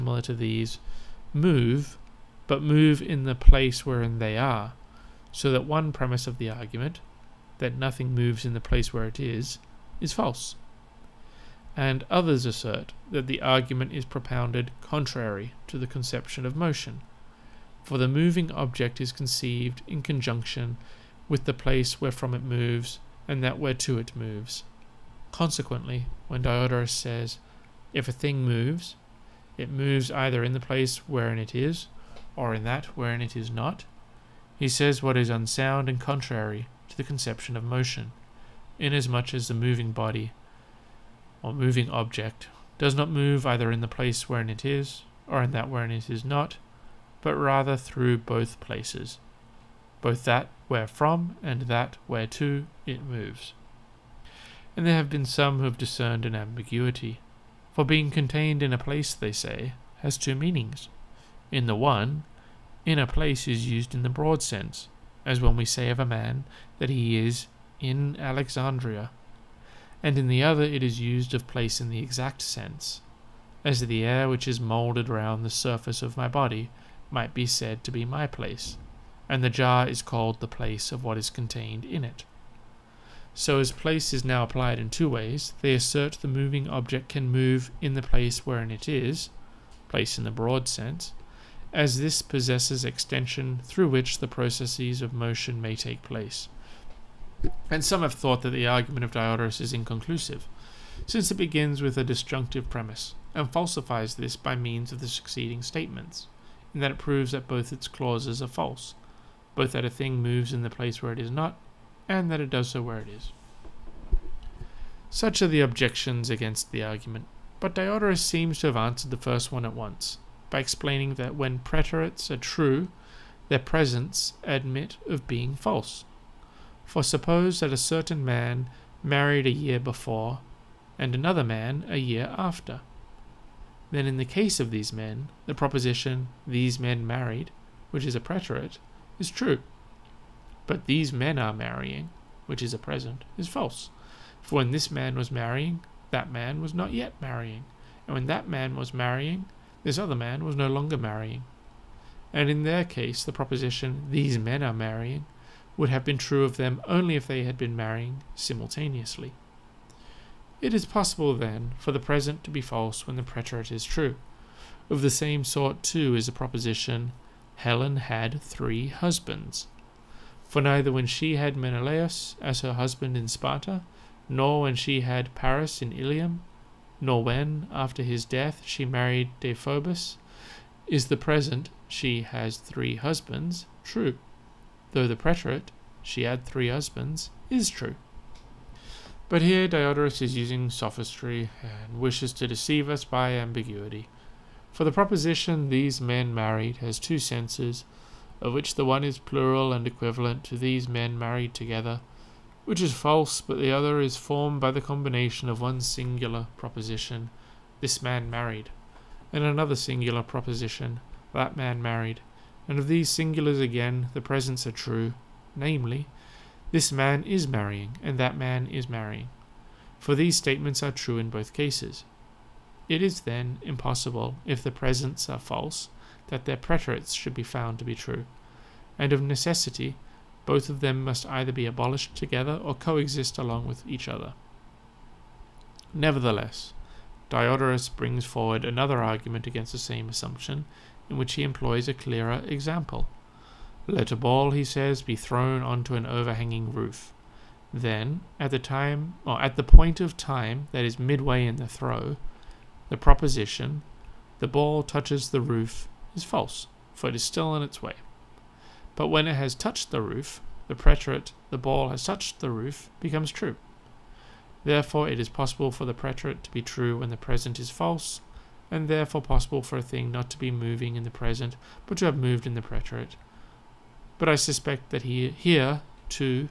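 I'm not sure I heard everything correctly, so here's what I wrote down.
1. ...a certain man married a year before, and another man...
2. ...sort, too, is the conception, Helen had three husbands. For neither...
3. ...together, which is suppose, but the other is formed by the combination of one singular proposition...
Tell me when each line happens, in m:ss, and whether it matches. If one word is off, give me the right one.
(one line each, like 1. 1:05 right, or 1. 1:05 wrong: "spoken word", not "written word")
1. 2:07 right
2. 2:45 wrong: "proposition", not "conception"
3. 3:21 wrong: "false", not "suppose".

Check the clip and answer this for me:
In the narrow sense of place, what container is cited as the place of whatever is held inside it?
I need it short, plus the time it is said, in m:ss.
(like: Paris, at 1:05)
The jar, at 1:19.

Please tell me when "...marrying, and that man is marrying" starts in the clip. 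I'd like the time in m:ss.
3:37.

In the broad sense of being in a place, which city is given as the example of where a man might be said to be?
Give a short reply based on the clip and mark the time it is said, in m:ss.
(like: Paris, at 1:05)
Alexandria, at 1:08.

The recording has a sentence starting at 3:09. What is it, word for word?
But here Diodorus is using sophistry and wishes to deceive us by ambiguity.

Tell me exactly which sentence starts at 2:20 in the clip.
But these men are marrying, which is a present, is false.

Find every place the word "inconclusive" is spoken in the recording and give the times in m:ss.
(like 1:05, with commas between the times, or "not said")
1:39.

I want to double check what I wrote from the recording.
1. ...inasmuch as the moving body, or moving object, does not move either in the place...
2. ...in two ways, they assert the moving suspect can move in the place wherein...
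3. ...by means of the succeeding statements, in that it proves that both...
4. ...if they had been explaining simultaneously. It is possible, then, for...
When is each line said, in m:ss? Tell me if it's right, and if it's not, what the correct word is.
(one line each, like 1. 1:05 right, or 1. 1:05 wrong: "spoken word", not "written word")
1. 0:38 right
2. 1:24 wrong: "object", not "suspect"
3. 1:44 right
4. 2:37 wrong: "marrying", not "explaining".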